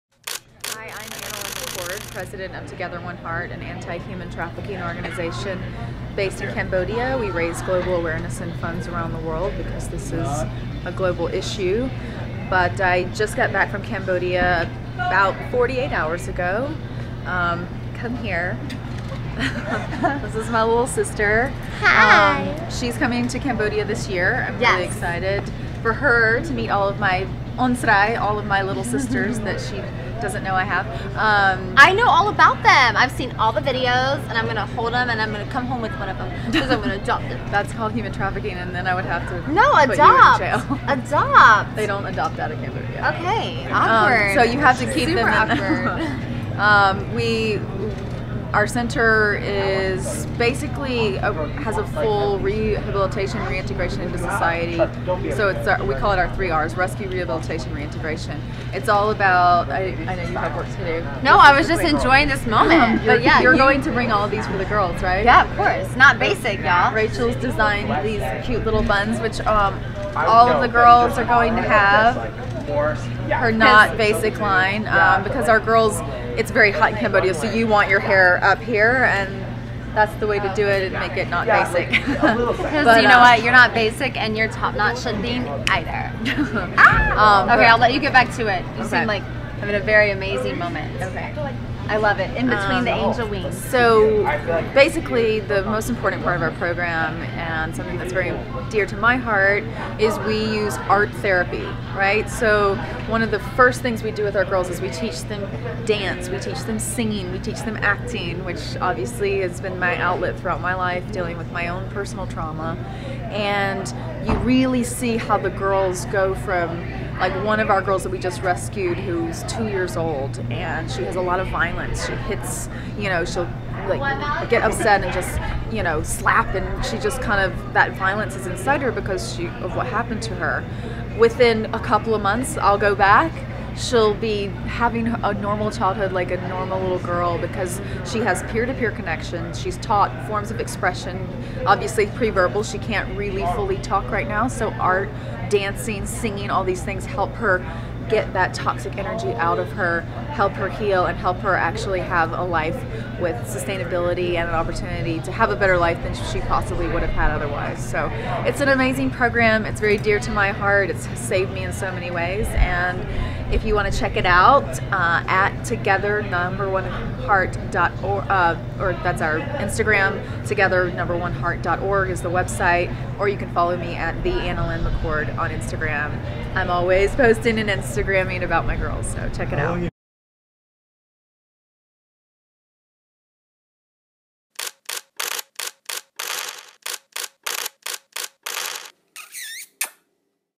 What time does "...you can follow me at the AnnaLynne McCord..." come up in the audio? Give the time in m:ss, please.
2:53.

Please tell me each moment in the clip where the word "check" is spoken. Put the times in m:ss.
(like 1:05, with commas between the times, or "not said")
2:43, 2:59.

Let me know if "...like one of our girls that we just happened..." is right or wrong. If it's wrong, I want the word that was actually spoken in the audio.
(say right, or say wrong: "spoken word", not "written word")
wrong: "rescued", not "happened".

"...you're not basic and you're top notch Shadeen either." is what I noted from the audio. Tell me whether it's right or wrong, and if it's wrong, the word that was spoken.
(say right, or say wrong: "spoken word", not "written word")
right.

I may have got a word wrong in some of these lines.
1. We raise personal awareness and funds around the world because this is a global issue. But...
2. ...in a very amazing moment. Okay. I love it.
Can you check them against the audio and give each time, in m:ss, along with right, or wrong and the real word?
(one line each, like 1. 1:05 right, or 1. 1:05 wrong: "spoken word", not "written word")
1. 0:07 wrong: "global", not "personal"
2. 1:29 right.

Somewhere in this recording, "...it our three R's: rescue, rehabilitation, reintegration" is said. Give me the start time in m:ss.
0:56.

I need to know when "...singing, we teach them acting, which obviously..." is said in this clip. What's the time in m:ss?
1:46.